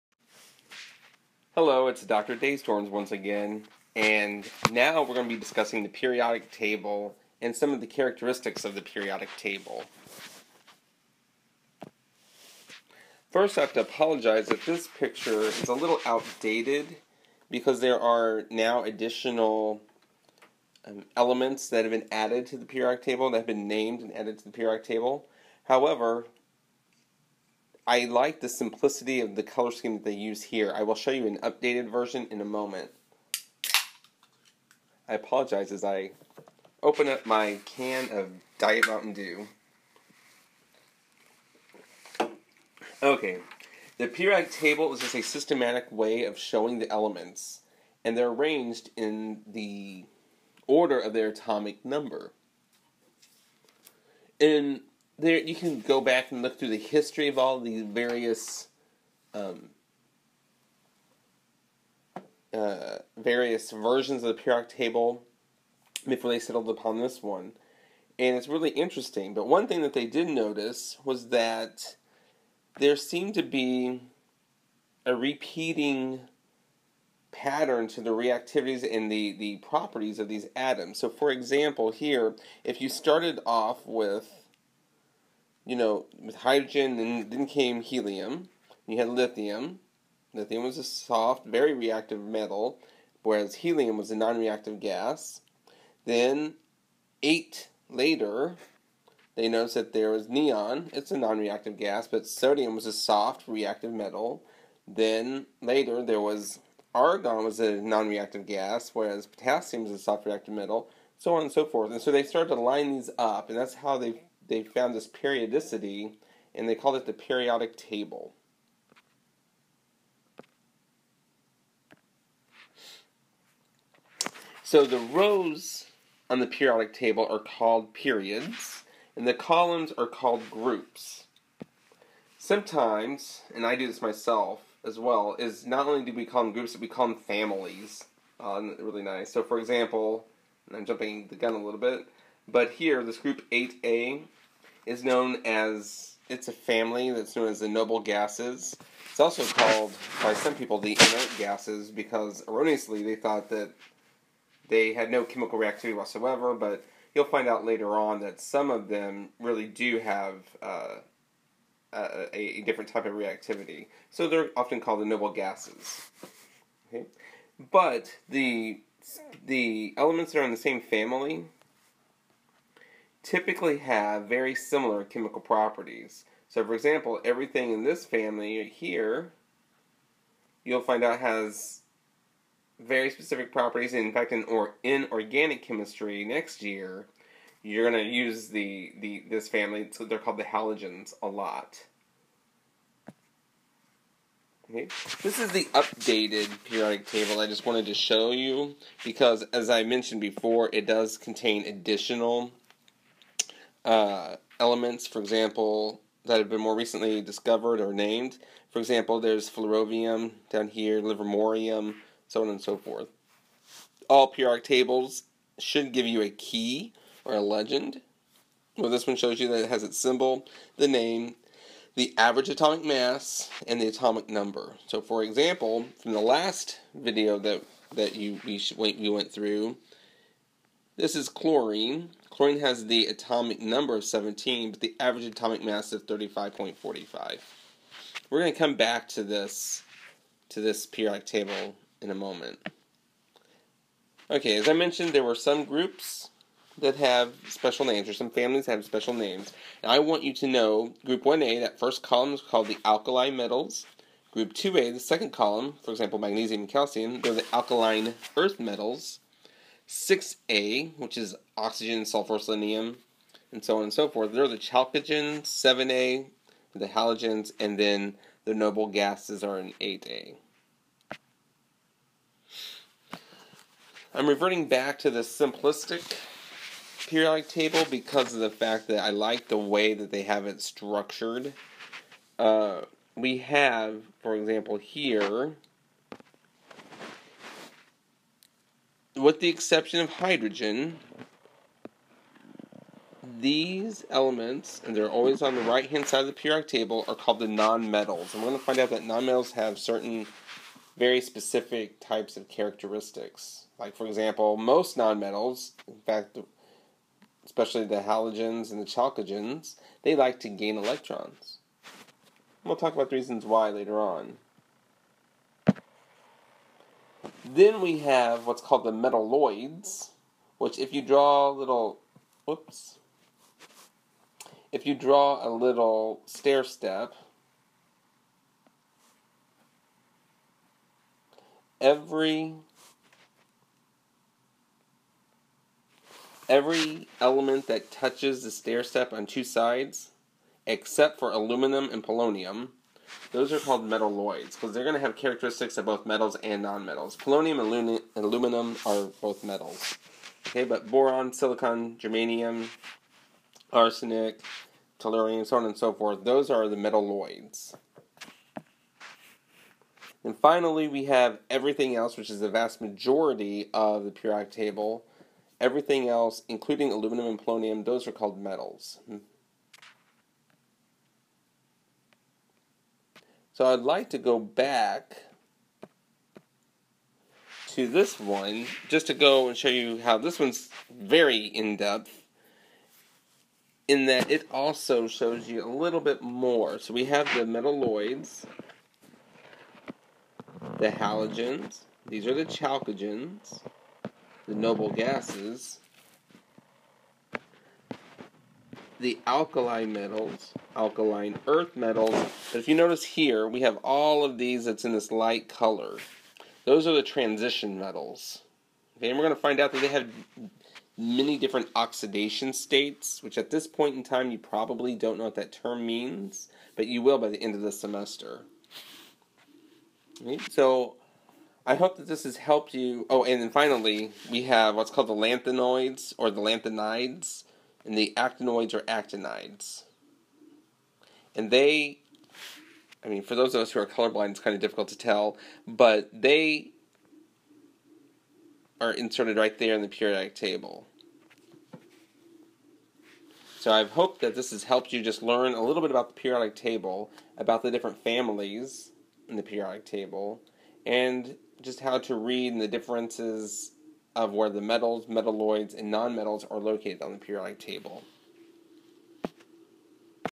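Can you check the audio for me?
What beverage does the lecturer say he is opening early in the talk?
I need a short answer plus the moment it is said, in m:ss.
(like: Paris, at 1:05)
Diet Mountain Dew, at 0:38.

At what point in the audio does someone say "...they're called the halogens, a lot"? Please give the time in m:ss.
3:10.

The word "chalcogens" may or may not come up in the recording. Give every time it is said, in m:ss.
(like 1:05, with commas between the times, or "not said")
4:24, 5:08, 6:32.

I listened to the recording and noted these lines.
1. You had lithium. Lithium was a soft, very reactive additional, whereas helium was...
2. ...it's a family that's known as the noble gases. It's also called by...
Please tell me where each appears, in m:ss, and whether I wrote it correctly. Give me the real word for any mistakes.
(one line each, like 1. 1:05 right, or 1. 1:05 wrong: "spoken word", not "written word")
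1. 1:28 wrong: "metal", not "additional"
2. 2:26 right.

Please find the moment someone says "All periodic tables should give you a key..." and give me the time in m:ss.
3:34.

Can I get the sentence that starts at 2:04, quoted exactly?
So the rows on the periodic table are called periods, and the columns are called groups.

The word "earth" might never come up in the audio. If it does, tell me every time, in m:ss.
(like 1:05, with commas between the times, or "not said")
4:18, 6:41.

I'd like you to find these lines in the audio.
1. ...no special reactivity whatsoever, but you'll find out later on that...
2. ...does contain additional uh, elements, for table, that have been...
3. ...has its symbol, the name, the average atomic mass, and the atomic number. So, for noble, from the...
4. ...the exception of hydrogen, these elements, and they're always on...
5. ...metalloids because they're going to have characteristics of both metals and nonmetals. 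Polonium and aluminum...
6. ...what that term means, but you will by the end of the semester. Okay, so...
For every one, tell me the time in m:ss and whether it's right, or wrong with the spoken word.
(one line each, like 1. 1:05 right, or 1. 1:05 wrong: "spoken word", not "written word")
1. 2:35 wrong: "chemical", not "special"
2. 3:20 wrong: "example", not "table"
3. 3:39 wrong: "example", not "noble"
4. 4:49 right
5. 5:43 right
6. 6:55 right.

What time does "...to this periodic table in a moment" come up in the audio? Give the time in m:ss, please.
4:00.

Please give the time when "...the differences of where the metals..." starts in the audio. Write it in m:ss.
7:32.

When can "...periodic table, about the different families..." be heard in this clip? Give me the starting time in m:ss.
7:26.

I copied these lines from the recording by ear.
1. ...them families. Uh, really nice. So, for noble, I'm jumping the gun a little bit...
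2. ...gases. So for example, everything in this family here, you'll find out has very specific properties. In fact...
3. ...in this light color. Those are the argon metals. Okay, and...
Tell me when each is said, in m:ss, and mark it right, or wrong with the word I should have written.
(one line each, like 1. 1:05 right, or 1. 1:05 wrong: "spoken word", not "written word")
1. 2:17 wrong: "example", not "noble"
2. 2:55 wrong: "properties", not "gases"
3. 6:44 wrong: "transition", not "argon".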